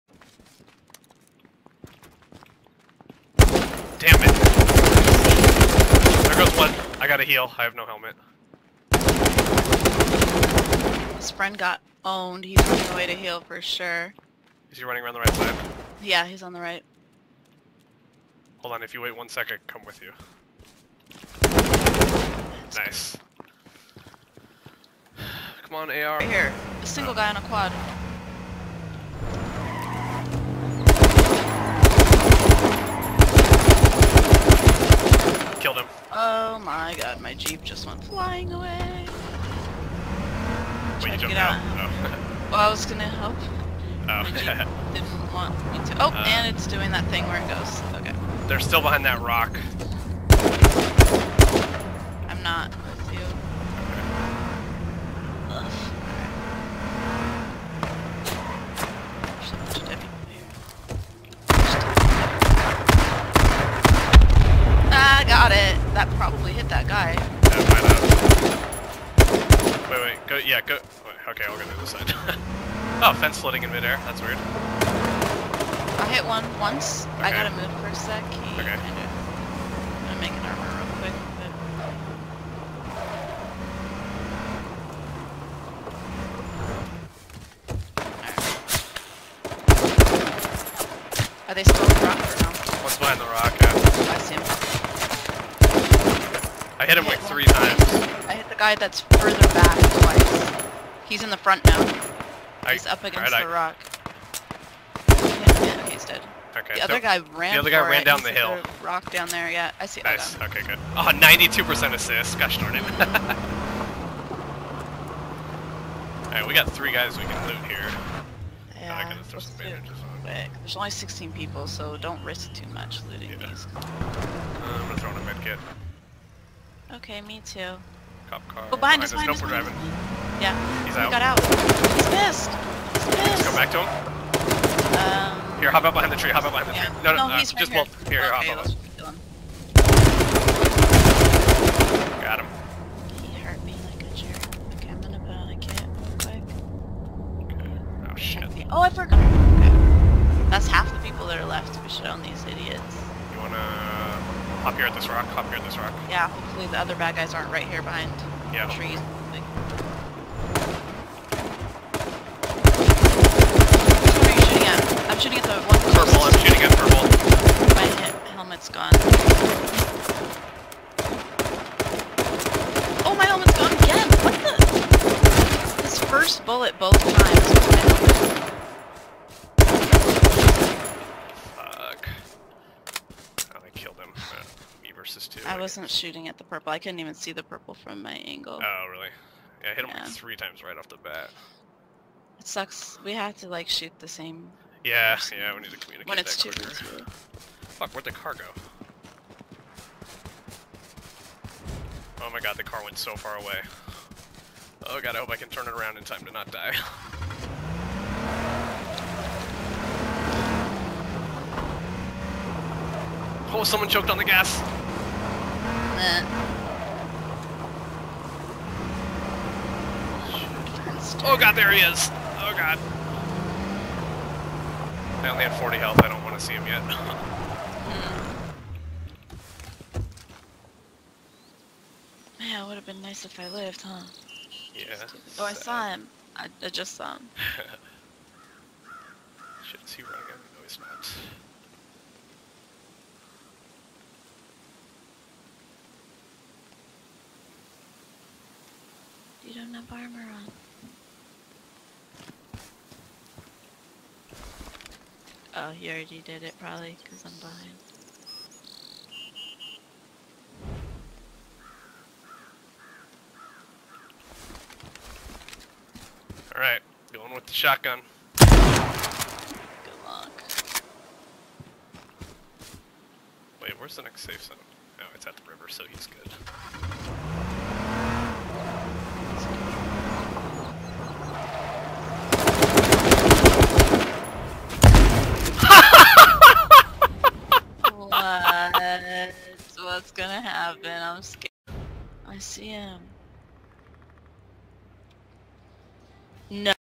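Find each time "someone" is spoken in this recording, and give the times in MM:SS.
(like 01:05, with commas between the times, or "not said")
03:33.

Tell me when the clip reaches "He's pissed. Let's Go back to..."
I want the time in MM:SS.
02:12.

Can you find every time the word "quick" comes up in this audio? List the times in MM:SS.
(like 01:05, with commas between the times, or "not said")
01:20, 02:27.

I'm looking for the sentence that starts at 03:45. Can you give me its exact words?
I only had 40 health, I don't want to see him yet.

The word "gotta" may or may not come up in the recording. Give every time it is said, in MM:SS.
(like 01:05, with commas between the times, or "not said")
00:07, 01:17.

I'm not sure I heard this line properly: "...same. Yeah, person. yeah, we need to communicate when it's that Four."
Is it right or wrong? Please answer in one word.
wrong.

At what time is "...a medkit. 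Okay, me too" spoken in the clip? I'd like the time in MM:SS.
02:05.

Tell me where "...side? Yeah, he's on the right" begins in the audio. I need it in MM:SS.
00:15.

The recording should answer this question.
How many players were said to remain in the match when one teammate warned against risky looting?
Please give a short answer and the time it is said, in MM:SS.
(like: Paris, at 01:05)
16, at 02:00.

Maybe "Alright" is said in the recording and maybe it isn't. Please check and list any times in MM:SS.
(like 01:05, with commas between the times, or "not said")
04:26.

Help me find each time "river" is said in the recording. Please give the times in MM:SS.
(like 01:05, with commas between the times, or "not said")
04:35.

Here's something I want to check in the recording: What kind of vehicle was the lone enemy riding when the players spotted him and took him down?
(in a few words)
quad.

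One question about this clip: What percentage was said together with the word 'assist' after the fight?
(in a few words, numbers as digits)
92 percent.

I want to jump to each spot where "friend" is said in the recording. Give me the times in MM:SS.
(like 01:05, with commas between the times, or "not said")
00:11.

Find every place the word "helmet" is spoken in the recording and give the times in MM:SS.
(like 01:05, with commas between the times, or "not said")
00:07, 02:48, 02:53.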